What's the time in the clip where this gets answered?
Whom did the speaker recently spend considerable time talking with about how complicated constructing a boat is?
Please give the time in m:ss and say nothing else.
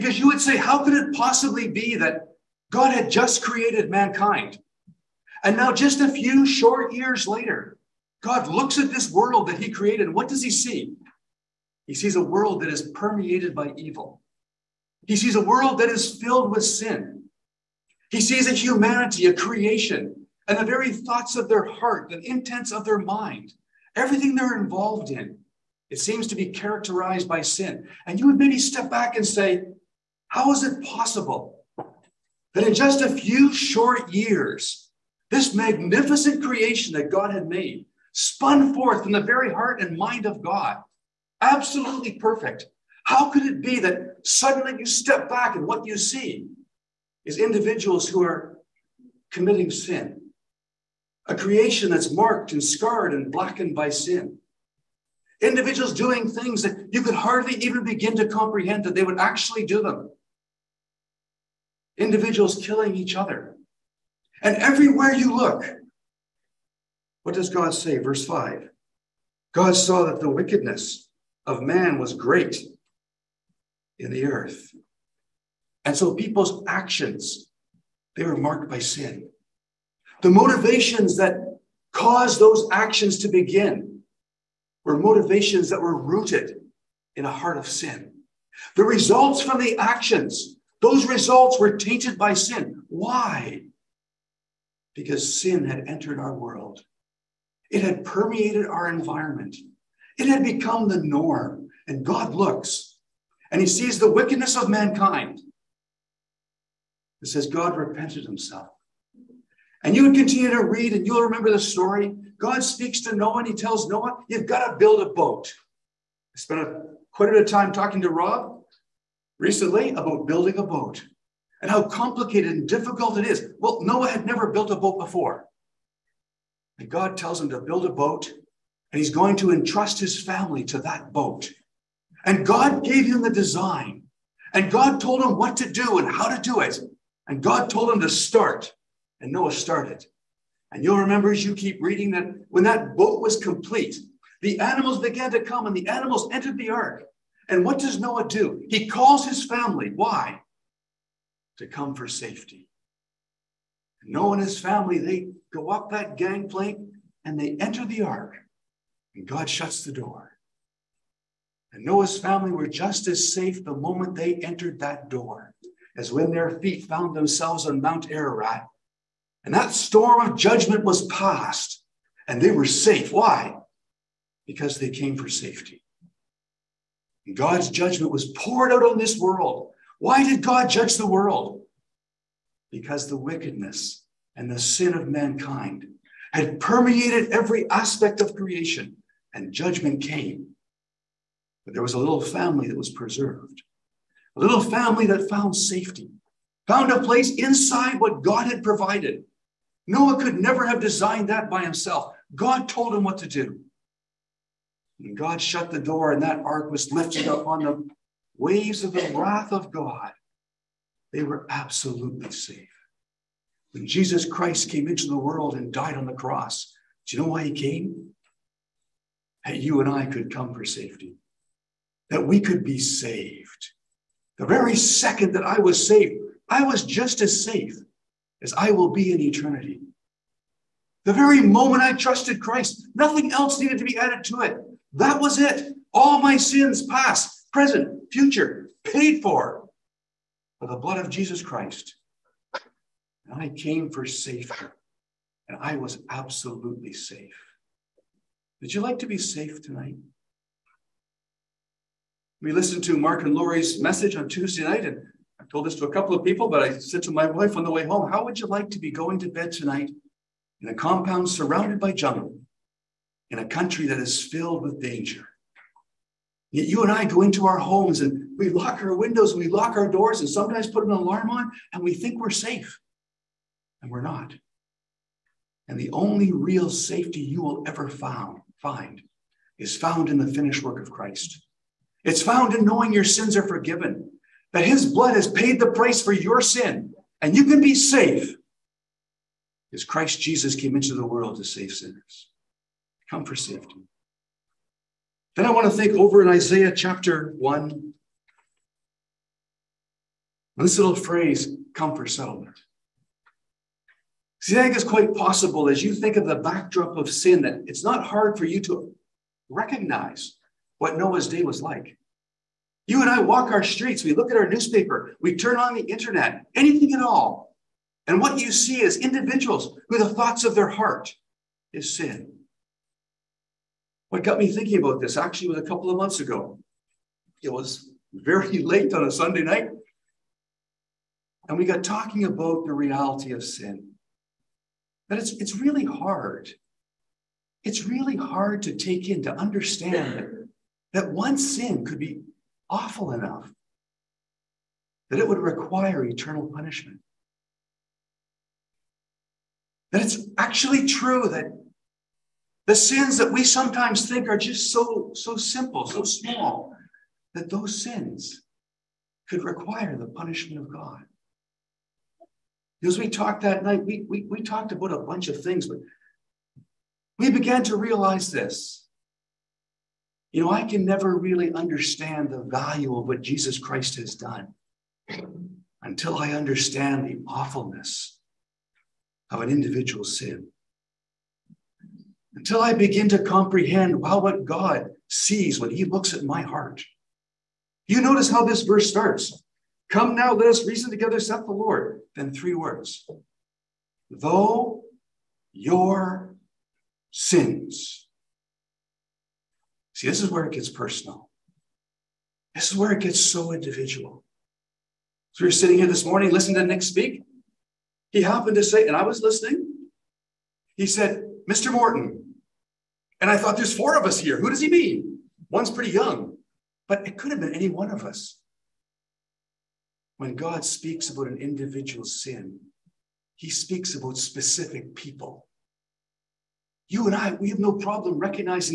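1:58.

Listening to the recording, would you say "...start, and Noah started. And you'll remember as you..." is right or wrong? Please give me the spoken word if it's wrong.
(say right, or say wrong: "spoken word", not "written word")
right.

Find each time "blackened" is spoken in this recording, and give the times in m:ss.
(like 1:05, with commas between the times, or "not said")
0:53.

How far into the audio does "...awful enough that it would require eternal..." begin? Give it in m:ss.
5:42.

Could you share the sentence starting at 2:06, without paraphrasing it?
And God tells him to build a boat and he's going to entrust his family to that boat.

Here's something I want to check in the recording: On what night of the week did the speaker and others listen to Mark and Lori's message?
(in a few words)
Tuesday.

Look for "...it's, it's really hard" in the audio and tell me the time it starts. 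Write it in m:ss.
5:35.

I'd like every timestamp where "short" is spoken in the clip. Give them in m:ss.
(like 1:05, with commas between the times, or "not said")
0:06, 0:33.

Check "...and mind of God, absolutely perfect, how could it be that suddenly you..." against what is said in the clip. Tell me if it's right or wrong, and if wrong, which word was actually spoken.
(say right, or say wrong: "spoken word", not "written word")
right.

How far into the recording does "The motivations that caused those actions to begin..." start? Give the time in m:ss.
1:20.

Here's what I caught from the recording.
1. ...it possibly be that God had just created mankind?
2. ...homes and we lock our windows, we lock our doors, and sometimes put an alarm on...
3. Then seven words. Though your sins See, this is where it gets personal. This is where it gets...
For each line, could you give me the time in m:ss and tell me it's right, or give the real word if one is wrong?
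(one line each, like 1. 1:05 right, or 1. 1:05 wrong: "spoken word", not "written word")
1. 0:00 right
2. 4:27 right
3. 6:32 wrong: "three", not "seven".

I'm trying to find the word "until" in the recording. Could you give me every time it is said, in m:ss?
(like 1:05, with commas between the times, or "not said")
6:15, 6:22.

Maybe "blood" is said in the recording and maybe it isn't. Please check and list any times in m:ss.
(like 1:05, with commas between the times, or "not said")
4:00, 4:44.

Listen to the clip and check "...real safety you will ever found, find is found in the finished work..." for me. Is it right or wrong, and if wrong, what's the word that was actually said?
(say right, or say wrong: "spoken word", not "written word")
right.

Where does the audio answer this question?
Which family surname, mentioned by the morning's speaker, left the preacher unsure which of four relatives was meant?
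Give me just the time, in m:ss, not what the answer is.
6:51.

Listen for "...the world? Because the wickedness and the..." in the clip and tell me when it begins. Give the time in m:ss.
3:00.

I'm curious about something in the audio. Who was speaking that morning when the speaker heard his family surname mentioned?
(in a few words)
Nick.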